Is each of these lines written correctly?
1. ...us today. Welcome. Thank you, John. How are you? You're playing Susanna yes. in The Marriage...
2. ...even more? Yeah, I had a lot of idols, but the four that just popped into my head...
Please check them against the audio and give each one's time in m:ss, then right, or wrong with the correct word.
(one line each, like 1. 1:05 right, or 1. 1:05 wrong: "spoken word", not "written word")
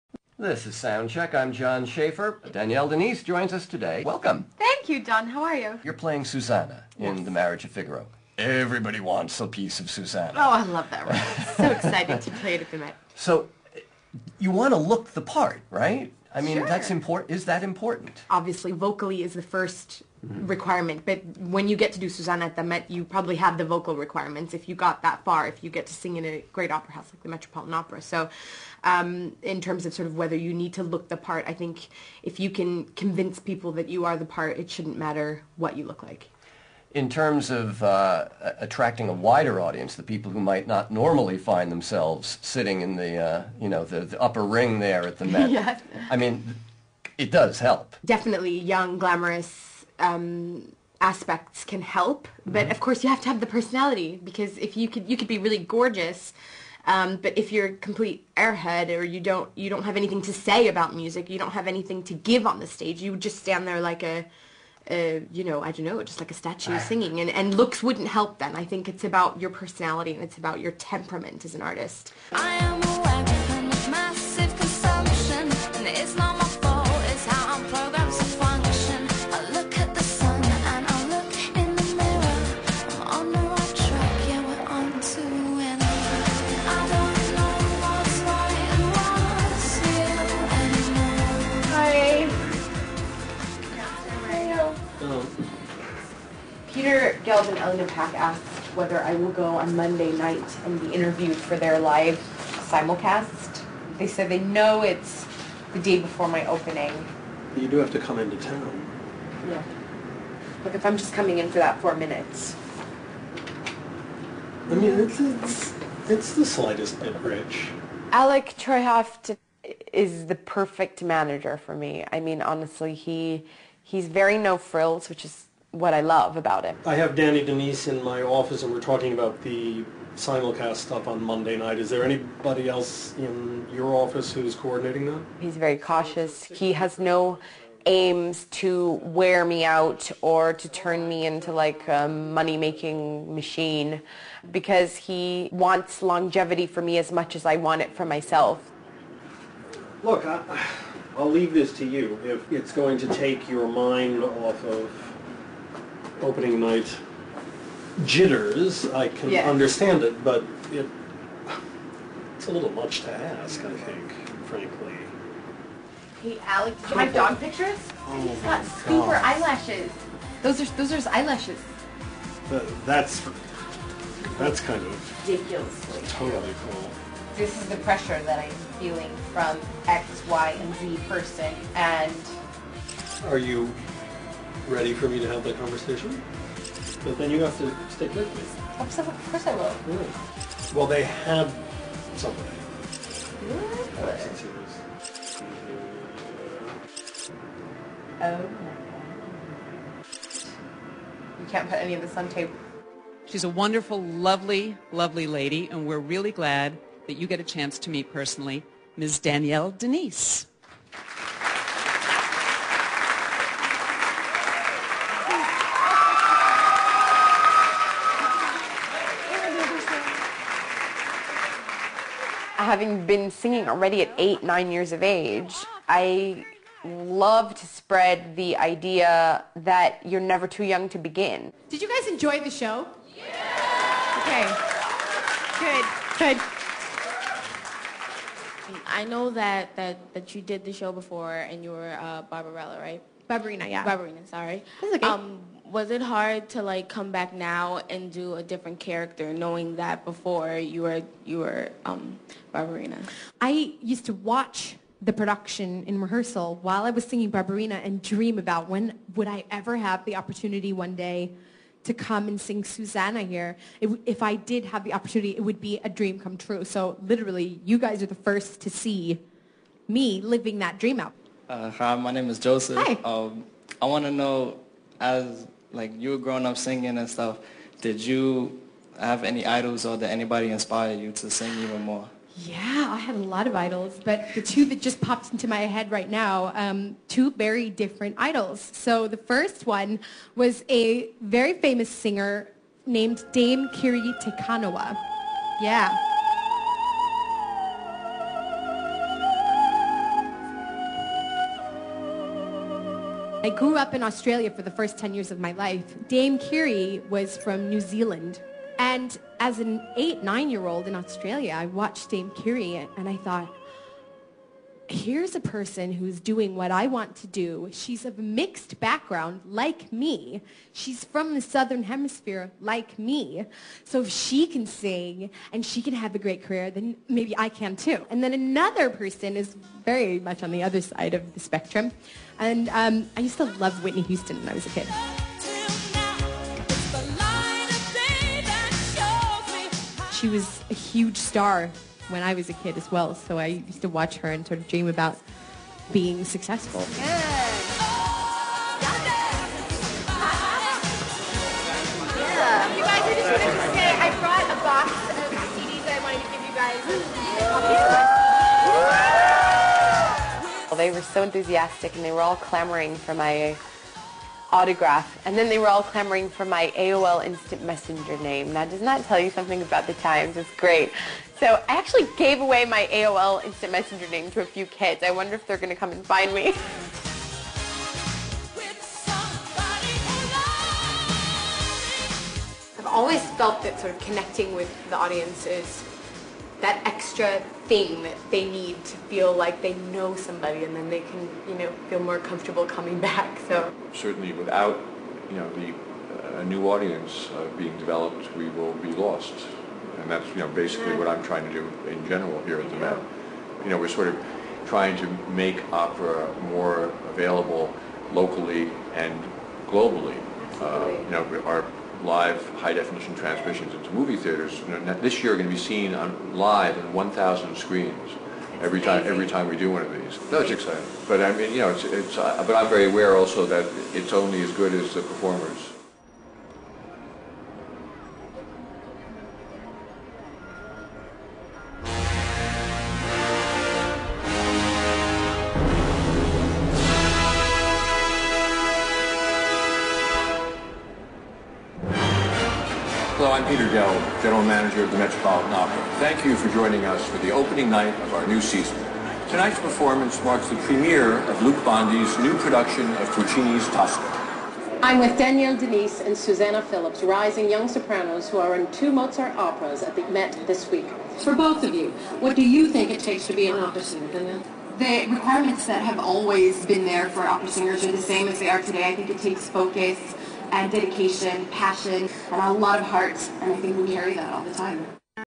1. 0:03 right
2. 4:41 wrong: "two", not "four".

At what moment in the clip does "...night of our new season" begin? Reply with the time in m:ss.
7:27.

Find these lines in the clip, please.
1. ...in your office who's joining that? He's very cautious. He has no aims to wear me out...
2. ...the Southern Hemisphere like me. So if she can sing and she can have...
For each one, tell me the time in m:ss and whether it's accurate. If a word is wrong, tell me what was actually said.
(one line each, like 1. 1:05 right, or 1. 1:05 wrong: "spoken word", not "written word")
1. 2:13 wrong: "coordinating", not "joining"
2. 5:21 right.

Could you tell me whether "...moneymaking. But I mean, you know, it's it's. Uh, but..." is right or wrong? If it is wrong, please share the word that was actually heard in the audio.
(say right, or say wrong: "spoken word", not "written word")
wrong: "exciting", not "moneymaking".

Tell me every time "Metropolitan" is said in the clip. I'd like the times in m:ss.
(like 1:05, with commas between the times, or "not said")
0:27, 7:24.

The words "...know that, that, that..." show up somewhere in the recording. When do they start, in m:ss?
3:59.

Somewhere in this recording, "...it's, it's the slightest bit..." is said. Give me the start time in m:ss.
1:55.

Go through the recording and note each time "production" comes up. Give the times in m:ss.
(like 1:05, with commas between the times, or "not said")
4:15, 7:32.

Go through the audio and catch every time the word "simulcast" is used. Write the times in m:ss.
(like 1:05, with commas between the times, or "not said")
1:42, 2:10.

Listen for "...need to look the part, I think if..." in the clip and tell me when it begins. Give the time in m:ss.
0:30.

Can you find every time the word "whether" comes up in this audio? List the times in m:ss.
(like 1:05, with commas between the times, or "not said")
0:30, 1:38.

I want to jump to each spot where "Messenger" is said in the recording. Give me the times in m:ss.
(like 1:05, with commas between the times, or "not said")
6:07, 6:13.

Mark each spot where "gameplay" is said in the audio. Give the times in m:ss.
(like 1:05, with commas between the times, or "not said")
not said.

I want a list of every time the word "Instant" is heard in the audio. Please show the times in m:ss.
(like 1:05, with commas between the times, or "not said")
6:07, 6:13.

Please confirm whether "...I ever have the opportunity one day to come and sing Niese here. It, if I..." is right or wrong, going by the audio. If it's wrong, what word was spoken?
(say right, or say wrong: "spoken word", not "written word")
wrong: "Susanna", not "Niese".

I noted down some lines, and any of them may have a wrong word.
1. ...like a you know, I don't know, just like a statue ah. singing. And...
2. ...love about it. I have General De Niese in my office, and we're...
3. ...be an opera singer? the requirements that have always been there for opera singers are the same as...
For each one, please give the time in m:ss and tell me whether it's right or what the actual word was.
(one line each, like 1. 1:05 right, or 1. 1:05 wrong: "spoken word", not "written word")
1. 1:03 right
2. 2:06 wrong: "Danny", not "General"
3. 7:43 right.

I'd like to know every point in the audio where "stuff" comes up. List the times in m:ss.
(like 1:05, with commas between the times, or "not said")
2:10, 4:37.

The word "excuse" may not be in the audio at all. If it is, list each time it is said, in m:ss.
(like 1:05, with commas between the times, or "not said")
not said.